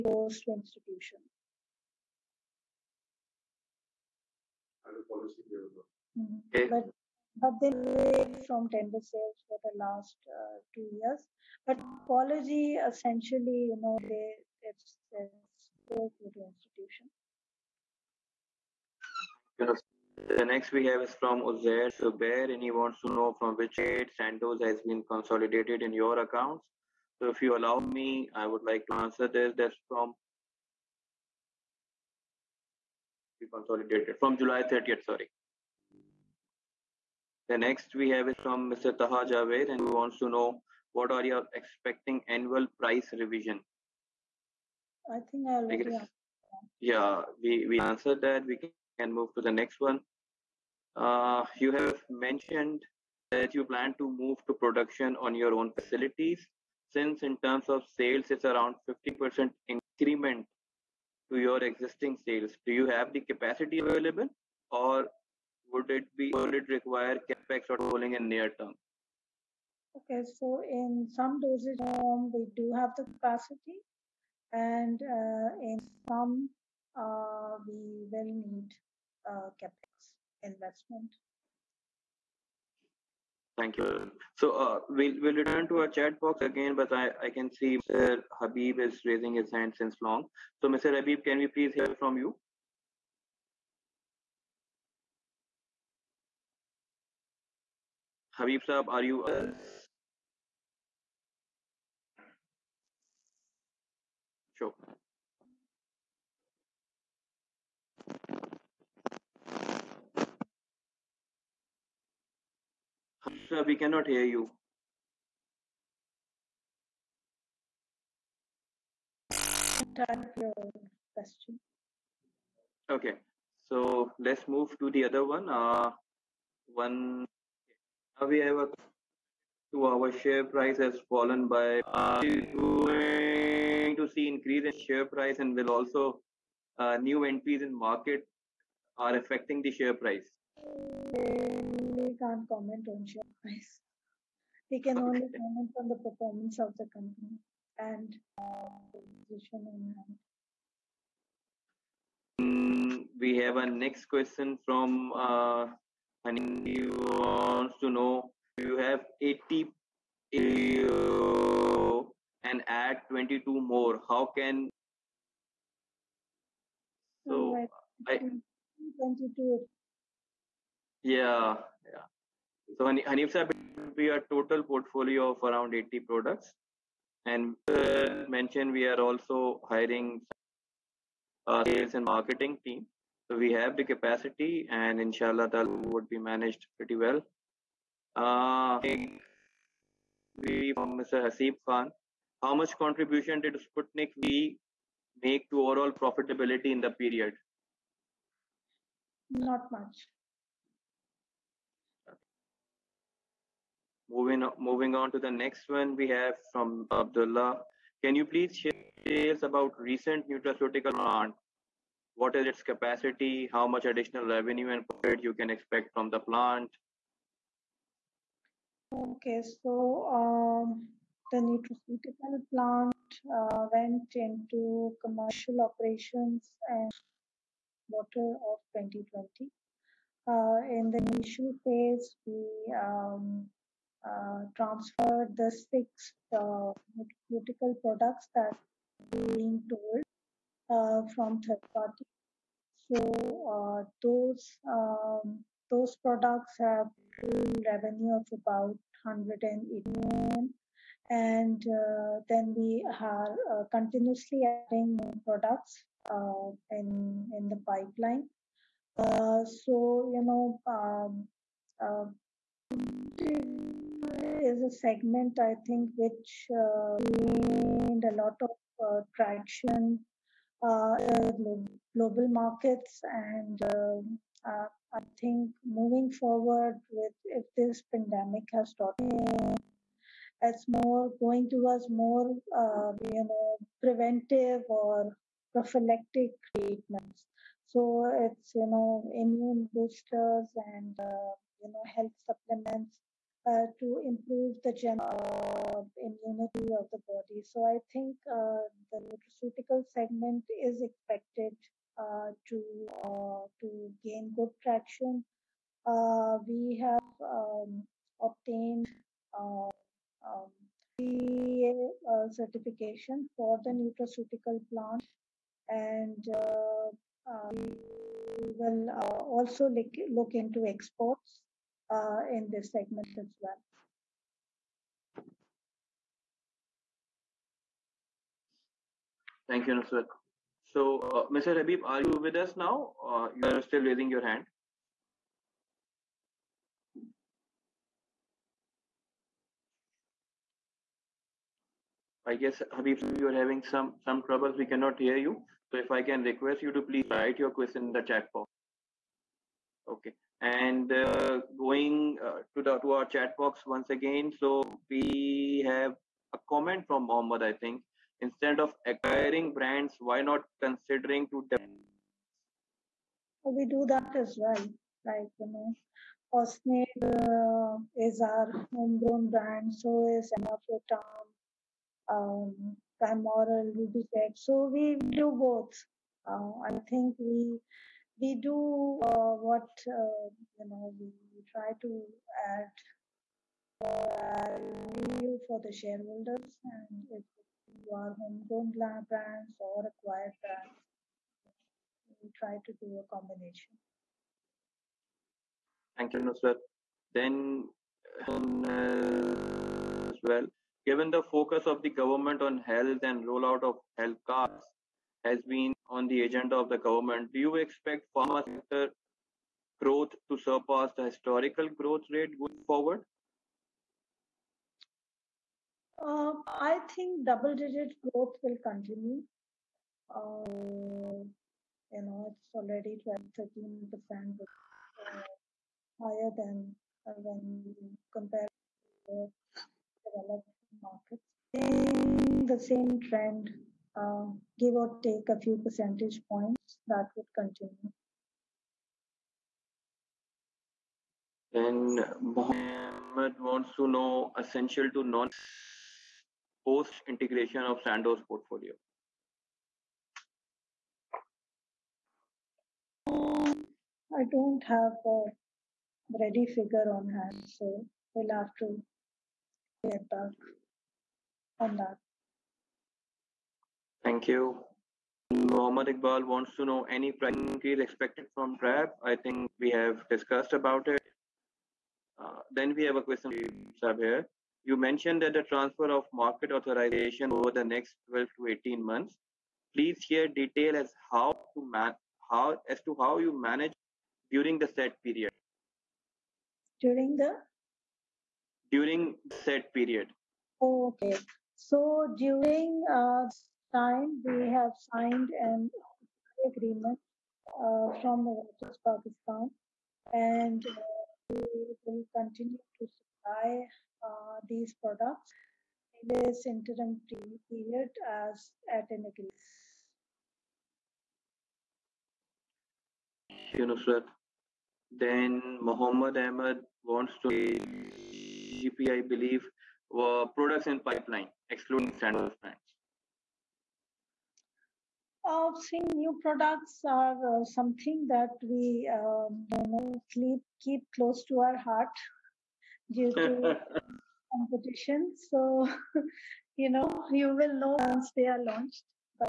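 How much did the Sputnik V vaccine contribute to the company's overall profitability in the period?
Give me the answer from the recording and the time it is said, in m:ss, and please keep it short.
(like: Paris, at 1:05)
Not much, at 3:19.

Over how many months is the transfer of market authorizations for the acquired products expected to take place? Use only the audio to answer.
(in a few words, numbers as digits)
12 to 18 months.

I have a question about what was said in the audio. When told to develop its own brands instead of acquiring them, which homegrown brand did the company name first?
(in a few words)
Osnade.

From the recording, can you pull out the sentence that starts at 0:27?
So if you allow me, I would like to answer this.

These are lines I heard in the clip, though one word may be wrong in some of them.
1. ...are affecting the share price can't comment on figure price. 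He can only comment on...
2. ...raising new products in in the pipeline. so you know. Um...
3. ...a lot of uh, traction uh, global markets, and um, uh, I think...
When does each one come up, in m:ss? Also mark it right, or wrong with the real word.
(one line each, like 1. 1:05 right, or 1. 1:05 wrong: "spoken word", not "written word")
1. 2:18 wrong: "share", not "figure"
2. 4:14 wrong: "adding", not "raising"
3. 4:28 right.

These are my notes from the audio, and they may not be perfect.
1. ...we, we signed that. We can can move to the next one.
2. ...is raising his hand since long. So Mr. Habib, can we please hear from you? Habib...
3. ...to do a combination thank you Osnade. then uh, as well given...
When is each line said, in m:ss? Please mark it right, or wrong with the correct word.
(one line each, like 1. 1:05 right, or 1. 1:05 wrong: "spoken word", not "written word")
1. 0:47 wrong: "answered", not "signed"
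2. 1:28 right
3. 6:32 wrong: "Nusrat", not "Osnade".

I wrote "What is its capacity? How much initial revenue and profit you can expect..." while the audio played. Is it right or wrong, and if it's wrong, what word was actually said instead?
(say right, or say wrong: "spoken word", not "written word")
wrong: "additional", not "initial".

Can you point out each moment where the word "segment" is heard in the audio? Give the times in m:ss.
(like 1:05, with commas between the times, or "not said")
4:24, 4:59, 5:22.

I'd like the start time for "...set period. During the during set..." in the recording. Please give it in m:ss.
8:04.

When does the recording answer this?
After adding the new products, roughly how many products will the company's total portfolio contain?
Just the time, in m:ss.
2:55.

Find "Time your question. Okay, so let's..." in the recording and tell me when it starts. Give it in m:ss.
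1:59.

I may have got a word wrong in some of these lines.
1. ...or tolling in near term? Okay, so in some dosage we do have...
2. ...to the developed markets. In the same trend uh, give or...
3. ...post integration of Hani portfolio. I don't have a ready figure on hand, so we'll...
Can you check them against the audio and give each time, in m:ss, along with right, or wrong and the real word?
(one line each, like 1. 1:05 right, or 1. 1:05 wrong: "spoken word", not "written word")
1. 1:07 right
2. 7:08 right
3. 7:26 wrong: "Sandoz", not "Hani".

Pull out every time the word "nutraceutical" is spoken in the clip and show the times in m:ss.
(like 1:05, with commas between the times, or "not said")
3:30, 3:41, 4:59, 5:13.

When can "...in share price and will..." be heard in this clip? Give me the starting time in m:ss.
2:14.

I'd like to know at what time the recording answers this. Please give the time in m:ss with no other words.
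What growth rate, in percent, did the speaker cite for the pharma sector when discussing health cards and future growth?
7:03.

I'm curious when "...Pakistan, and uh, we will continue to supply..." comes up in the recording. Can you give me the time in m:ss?
8:18.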